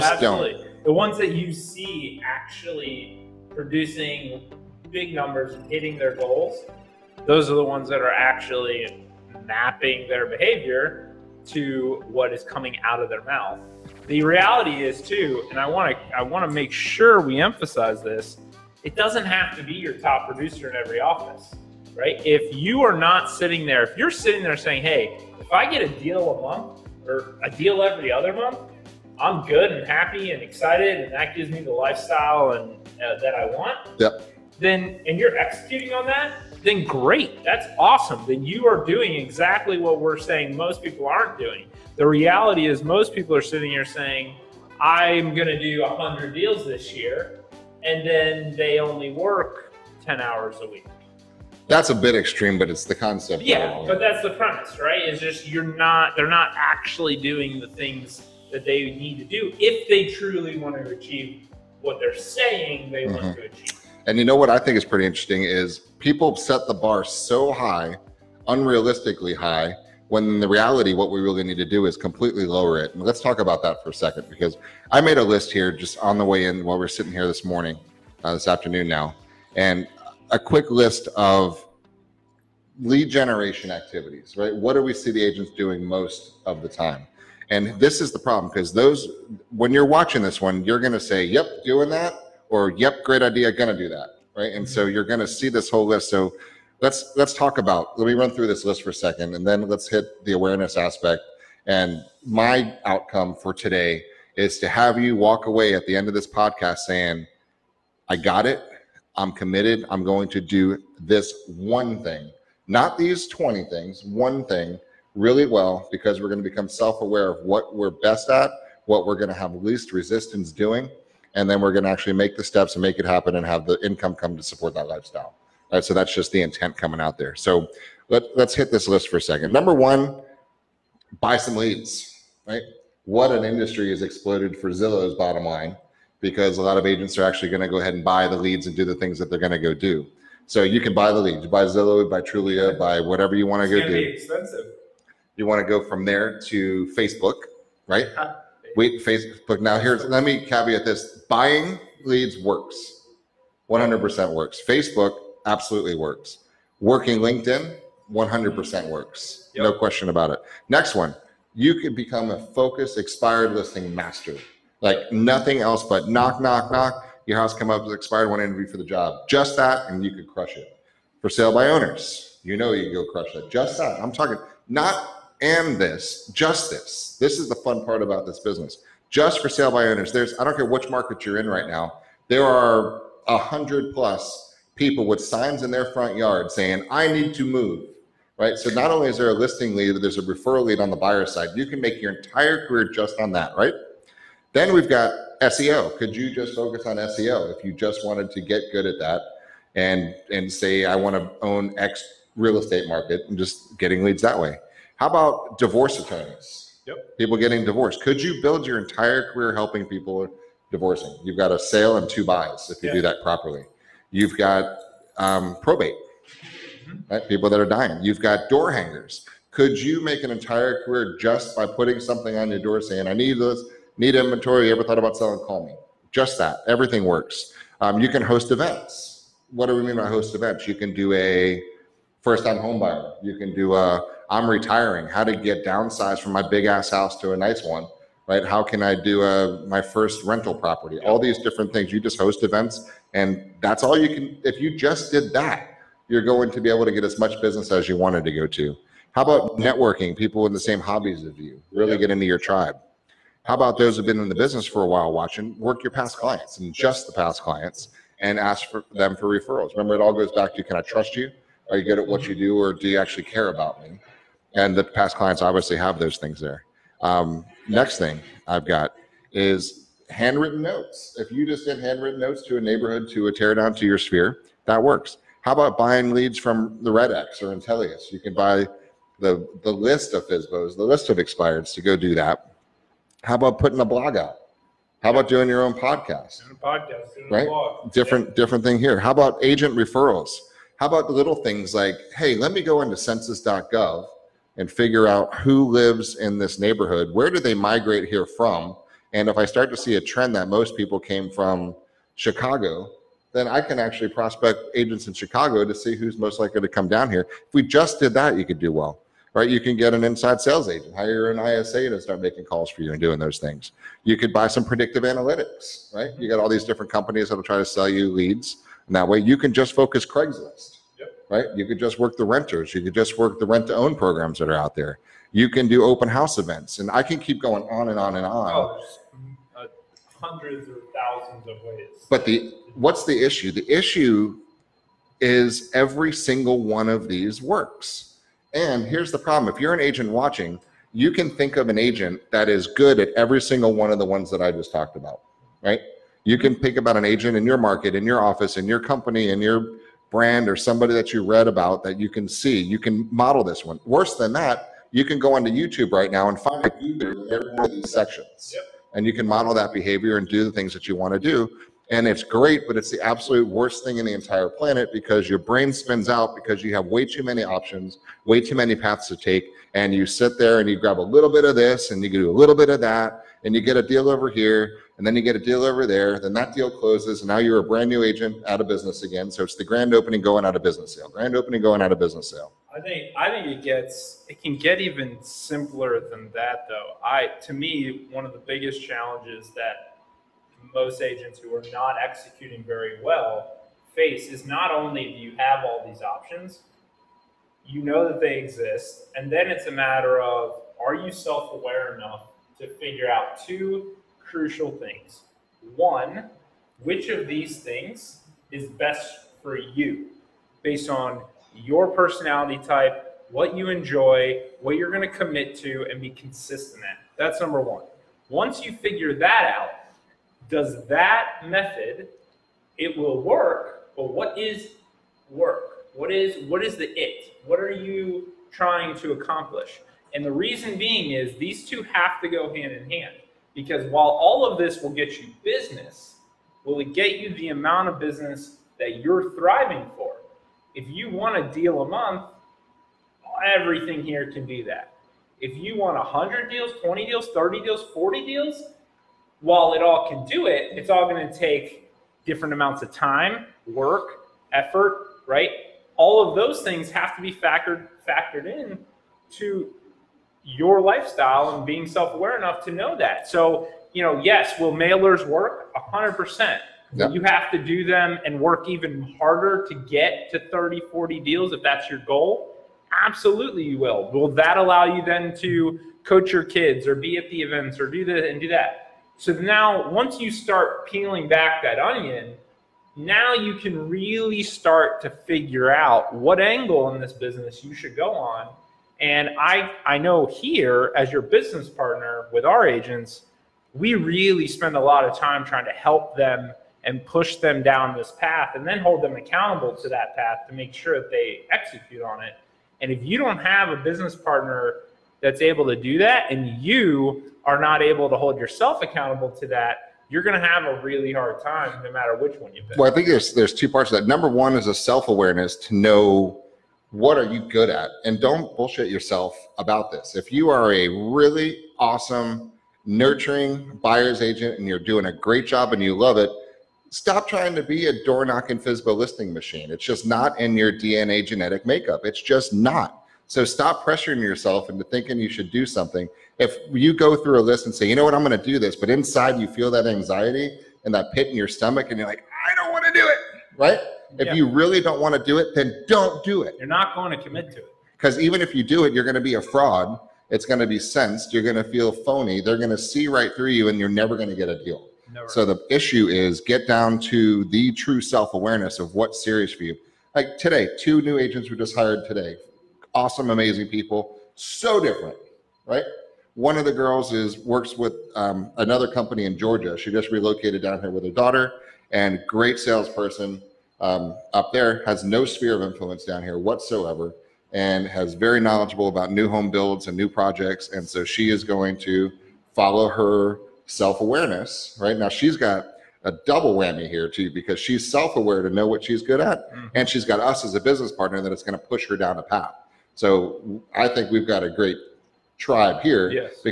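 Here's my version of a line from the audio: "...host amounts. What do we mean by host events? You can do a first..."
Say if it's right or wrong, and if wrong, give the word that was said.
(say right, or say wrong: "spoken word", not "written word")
wrong: "events", not "amounts".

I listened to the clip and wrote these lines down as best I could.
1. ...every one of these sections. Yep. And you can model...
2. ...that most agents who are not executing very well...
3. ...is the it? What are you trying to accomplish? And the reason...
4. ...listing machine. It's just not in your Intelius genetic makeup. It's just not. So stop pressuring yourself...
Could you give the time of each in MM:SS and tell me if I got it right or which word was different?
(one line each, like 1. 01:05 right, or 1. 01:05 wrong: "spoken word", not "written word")
1. 05:56 right
2. 06:29 right
3. 07:06 right
4. 08:48 wrong: "DNA", not "Intelius".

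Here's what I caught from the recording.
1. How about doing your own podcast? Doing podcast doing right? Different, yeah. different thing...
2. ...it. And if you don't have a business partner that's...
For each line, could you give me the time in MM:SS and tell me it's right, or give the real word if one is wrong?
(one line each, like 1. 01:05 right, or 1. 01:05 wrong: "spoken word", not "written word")
1. 04:45 right
2. 08:22 right.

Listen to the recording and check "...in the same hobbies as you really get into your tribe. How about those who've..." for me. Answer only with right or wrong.
right.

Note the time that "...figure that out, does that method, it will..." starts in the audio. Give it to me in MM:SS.
06:58.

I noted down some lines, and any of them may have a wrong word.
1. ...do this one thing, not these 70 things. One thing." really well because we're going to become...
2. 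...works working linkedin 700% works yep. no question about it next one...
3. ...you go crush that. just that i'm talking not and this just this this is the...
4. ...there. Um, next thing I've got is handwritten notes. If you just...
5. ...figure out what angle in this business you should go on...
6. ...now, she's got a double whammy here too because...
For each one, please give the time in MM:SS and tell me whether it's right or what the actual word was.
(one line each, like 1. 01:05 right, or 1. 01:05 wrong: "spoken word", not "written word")
1. 01:50 wrong: "20", not "70"
2. 02:35 wrong: "100", not "700"
3. 02:52 right
4. 04:26 right
5. 08:05 right
6. 09:44 right.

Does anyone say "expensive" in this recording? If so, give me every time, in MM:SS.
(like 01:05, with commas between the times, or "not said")
02:23.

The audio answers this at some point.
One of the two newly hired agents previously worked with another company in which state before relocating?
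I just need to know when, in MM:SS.
09:29.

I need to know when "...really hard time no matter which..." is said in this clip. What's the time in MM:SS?
08:30.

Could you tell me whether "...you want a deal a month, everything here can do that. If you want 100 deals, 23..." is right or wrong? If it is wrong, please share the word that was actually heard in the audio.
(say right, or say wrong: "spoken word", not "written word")
wrong: "20", not "23".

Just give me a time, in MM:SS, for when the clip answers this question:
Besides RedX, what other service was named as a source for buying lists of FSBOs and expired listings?
04:37.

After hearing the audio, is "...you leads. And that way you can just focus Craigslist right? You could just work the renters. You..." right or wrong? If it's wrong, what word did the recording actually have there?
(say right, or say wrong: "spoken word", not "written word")
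right.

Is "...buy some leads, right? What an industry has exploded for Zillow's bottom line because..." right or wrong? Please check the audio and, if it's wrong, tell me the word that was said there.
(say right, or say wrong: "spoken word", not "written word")
right.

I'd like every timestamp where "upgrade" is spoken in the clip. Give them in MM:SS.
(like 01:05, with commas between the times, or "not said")
not said.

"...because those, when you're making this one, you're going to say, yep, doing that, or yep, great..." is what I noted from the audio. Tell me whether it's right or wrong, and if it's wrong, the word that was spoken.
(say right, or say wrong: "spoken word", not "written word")
wrong: "watching", not "making".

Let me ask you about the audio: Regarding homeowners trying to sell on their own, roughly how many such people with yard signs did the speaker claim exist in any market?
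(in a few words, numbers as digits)
100 plus.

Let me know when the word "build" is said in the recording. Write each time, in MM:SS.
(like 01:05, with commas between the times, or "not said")
03:28, 09:39.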